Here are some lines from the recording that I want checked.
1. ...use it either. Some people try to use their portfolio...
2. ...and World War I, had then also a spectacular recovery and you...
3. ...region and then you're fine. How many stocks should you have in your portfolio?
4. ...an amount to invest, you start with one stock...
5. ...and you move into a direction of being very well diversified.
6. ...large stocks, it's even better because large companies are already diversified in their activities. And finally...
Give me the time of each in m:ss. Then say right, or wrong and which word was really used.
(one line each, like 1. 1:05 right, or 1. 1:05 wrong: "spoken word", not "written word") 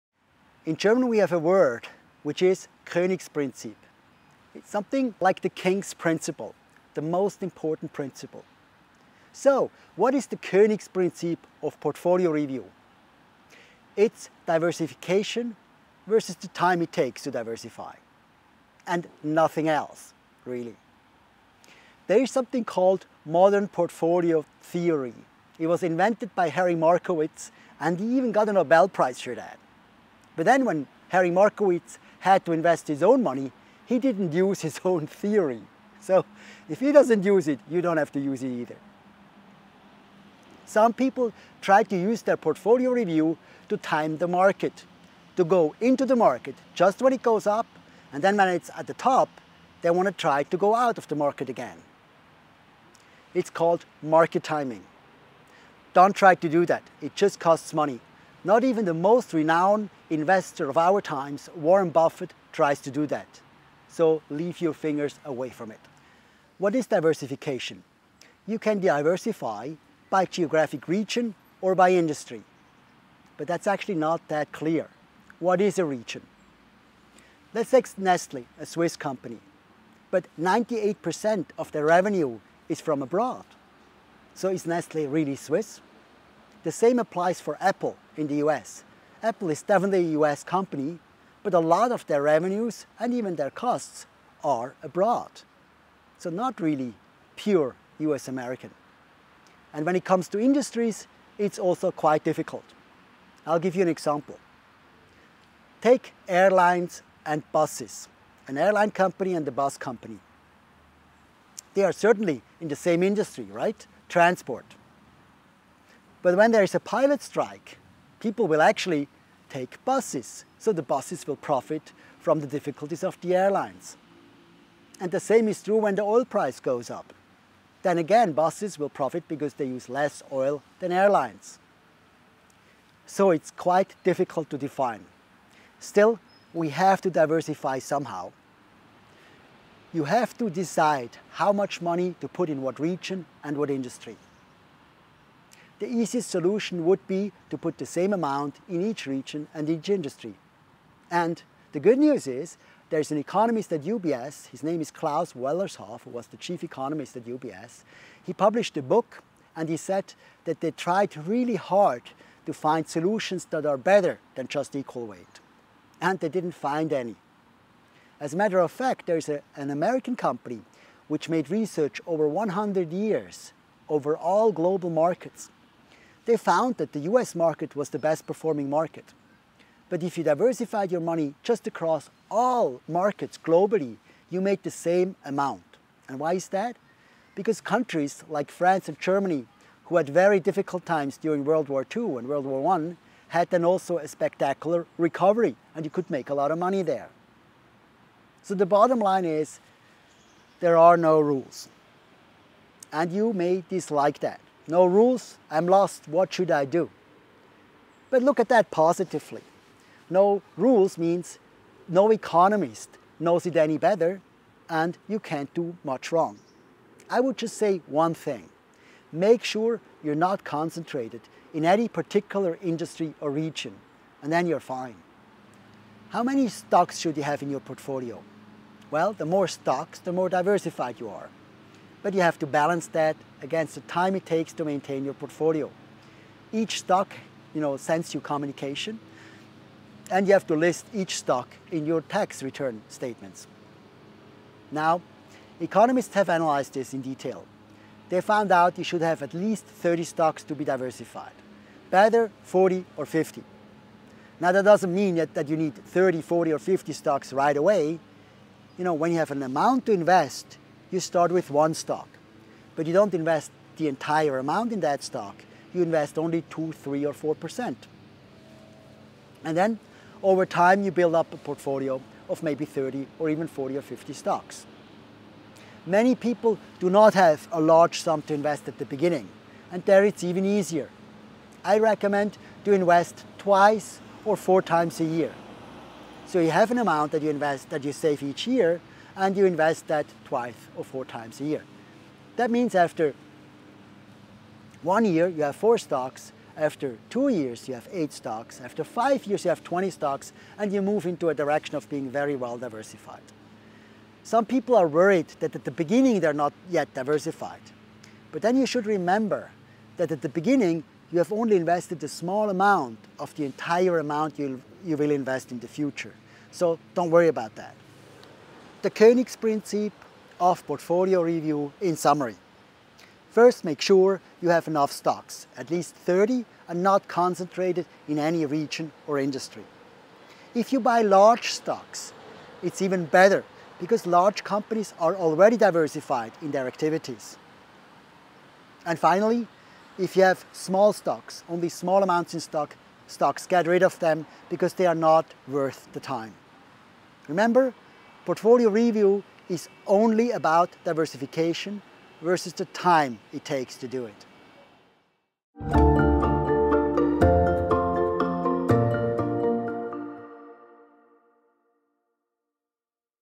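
1. 0:38 right
2. 3:12 right
3. 3:43 right
4. 4:19 right
5. 5:00 right
6. 5:31 right.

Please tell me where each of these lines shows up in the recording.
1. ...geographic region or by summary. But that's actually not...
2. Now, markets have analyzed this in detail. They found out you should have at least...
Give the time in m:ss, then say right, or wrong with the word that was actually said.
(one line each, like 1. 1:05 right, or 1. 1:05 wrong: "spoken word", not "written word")
1. 1:10 wrong: "industry", not "summary"
2. 4:04 wrong: "economists", not "markets".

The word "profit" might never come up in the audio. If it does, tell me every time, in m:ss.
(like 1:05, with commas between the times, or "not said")
2:01, 2:08.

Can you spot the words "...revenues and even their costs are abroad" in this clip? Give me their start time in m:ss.
1:32.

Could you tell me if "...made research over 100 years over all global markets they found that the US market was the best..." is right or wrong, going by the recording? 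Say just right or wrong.
right.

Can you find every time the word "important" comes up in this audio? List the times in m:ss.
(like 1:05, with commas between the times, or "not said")
0:07.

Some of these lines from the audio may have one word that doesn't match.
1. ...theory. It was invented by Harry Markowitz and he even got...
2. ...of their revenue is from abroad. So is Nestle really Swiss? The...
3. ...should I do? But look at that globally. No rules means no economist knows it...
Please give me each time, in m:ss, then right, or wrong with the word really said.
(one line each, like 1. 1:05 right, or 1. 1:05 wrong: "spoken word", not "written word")
1. 0:24 right
2. 1:21 right
3. 3:26 wrong: "positively", not "globally".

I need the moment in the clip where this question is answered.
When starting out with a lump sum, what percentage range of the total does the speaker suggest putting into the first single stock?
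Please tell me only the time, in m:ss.
4:26.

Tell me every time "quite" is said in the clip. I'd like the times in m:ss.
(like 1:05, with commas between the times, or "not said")
1:41, 2:13.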